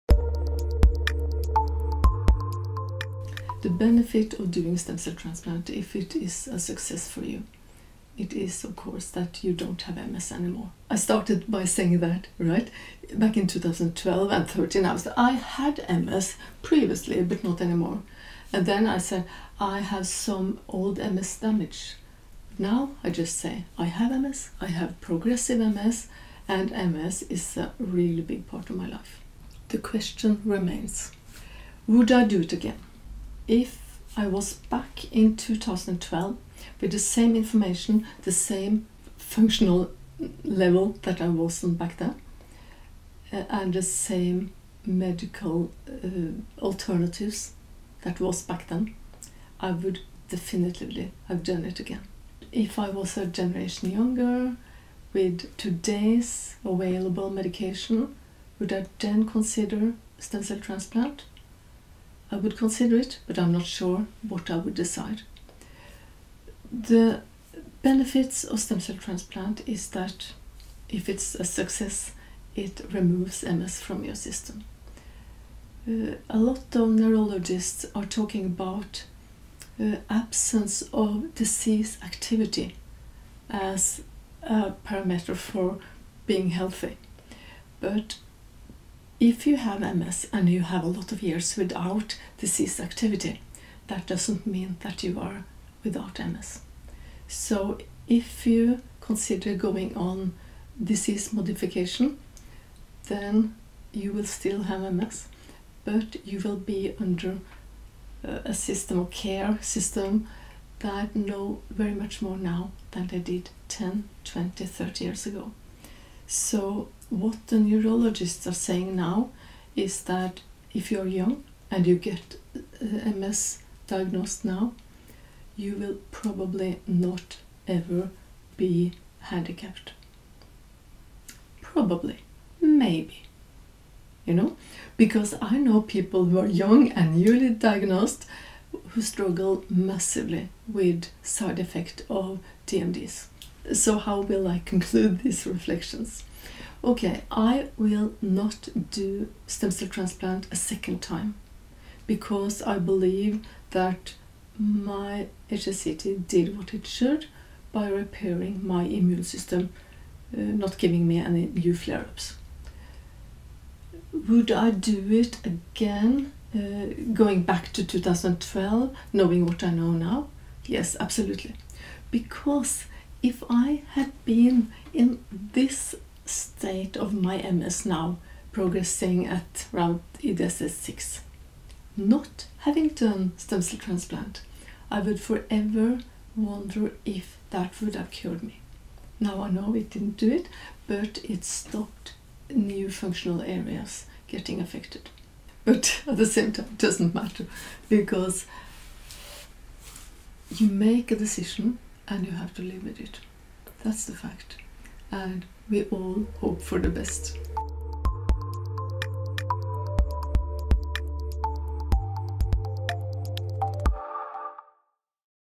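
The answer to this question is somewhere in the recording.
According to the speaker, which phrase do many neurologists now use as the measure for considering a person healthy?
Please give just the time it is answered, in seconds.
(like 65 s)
80 s.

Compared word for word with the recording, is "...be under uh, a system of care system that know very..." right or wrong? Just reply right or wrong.
right.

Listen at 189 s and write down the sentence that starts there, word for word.
Now I know it didn't do it, but it stopped new functional areas getting affected.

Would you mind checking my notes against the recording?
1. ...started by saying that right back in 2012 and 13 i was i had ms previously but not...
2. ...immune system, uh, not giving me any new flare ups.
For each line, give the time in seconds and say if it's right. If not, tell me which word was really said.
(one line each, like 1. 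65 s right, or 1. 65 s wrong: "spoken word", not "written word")
1. 10 s right
2. 158 s right.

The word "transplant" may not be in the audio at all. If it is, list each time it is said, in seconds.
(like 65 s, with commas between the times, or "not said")
5 s, 60 s, 68 s, 149 s, 183 s.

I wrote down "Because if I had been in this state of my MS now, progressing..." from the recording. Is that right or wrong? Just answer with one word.
right.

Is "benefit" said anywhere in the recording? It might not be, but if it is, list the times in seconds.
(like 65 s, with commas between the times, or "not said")
3 s, 67 s.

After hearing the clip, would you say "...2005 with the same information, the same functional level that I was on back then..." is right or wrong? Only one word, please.
wrong.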